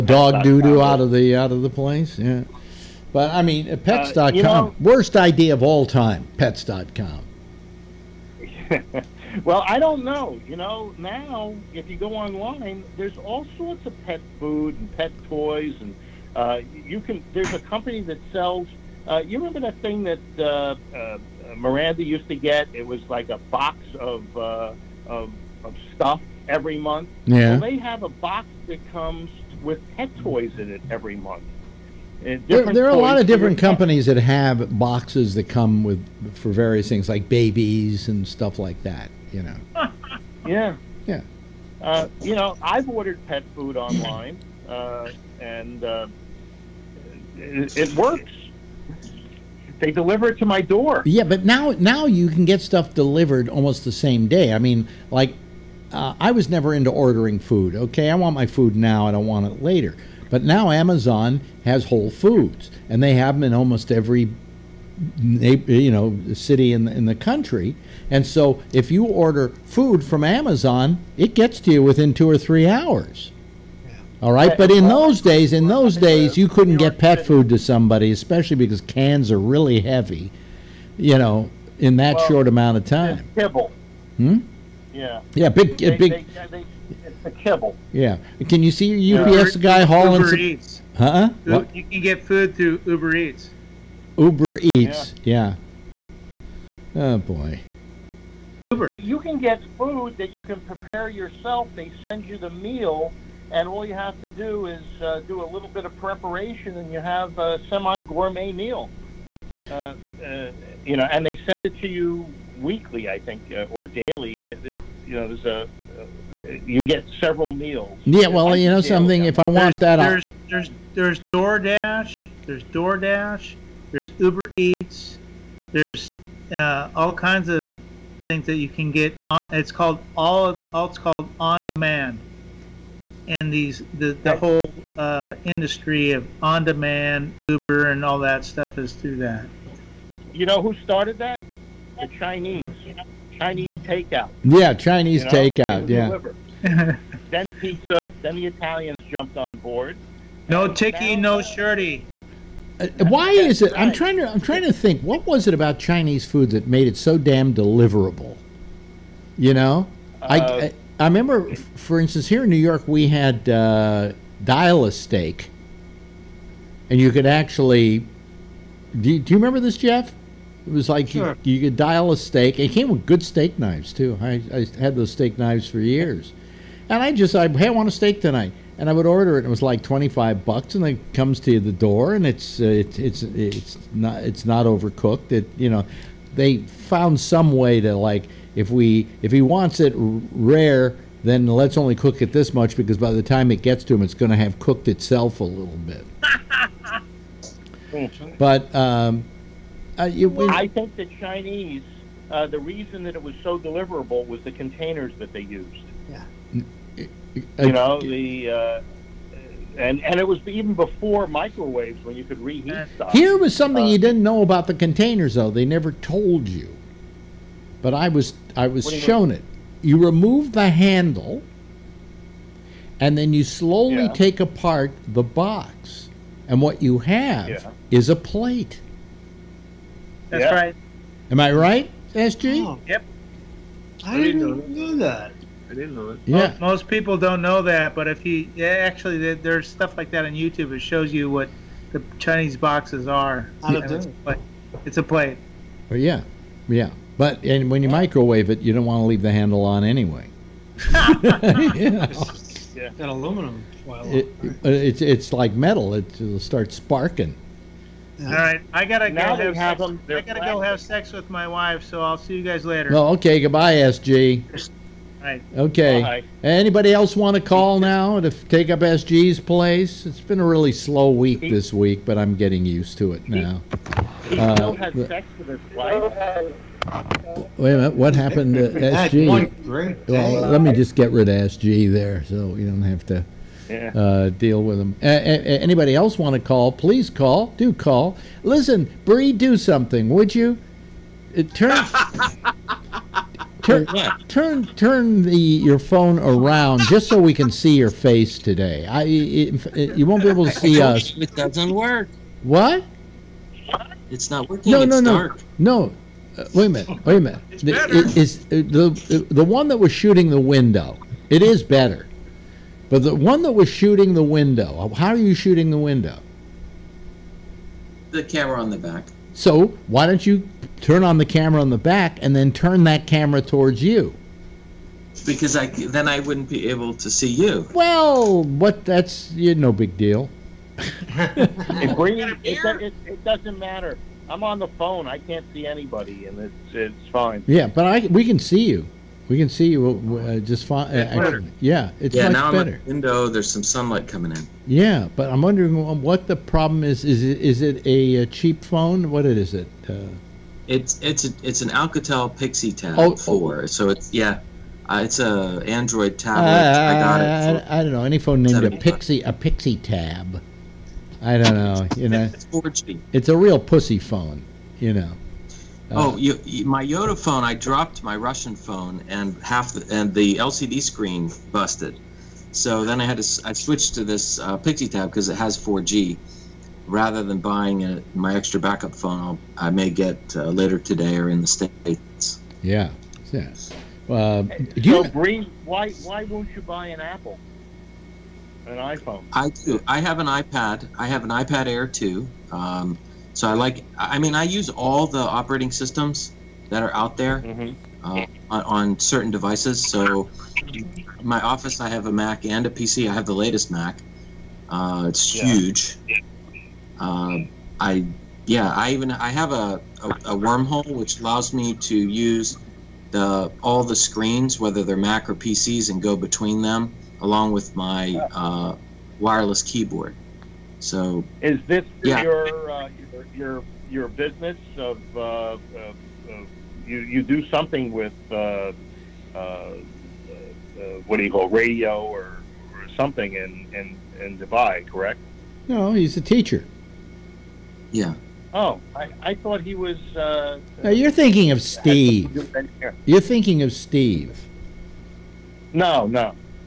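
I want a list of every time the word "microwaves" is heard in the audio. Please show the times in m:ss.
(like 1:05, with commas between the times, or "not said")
3:31, 4:07.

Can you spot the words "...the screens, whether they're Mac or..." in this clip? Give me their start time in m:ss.
6:53.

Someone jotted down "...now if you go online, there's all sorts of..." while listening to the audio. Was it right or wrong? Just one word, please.
right.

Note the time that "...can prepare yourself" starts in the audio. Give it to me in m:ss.
1:40.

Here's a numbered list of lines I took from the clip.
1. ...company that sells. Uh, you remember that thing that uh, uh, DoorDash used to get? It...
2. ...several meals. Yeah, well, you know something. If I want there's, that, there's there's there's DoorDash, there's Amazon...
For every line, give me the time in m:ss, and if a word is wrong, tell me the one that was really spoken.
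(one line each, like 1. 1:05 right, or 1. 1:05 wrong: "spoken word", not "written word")
1. 0:17 wrong: "Miranda", not "DoorDash"
2. 1:57 wrong: "DoorDash", not "Amazon".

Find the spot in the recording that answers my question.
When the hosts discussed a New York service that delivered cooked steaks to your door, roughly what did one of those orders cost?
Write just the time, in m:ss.
2:59.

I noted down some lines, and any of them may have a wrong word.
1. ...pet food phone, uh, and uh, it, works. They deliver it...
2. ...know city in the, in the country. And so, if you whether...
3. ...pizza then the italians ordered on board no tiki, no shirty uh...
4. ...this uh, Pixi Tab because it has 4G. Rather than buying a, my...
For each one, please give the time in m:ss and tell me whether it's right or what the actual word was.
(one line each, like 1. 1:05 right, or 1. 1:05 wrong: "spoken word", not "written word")
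1. 0:43 wrong: "online", not "phone"
2. 1:05 wrong: "order", not "whether"
3. 2:27 wrong: "jumped", not "ordered"
4. 6:14 right.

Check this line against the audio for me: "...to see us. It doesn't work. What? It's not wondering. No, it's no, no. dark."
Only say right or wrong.
wrong.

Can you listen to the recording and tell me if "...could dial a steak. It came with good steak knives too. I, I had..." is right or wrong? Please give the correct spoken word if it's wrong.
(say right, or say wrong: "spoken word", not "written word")
right.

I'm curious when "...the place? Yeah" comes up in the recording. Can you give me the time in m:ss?
0:01.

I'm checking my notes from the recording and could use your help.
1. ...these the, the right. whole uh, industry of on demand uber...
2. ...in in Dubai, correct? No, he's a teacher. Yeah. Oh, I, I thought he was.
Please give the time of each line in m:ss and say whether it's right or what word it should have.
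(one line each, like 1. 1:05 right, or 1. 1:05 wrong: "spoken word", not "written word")
1. 2:13 right
2. 7:13 right.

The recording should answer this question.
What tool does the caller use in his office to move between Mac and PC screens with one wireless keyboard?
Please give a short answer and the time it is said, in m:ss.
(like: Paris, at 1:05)
Wormhole, at 6:50.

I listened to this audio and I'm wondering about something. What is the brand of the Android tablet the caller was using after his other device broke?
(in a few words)
Alcatel.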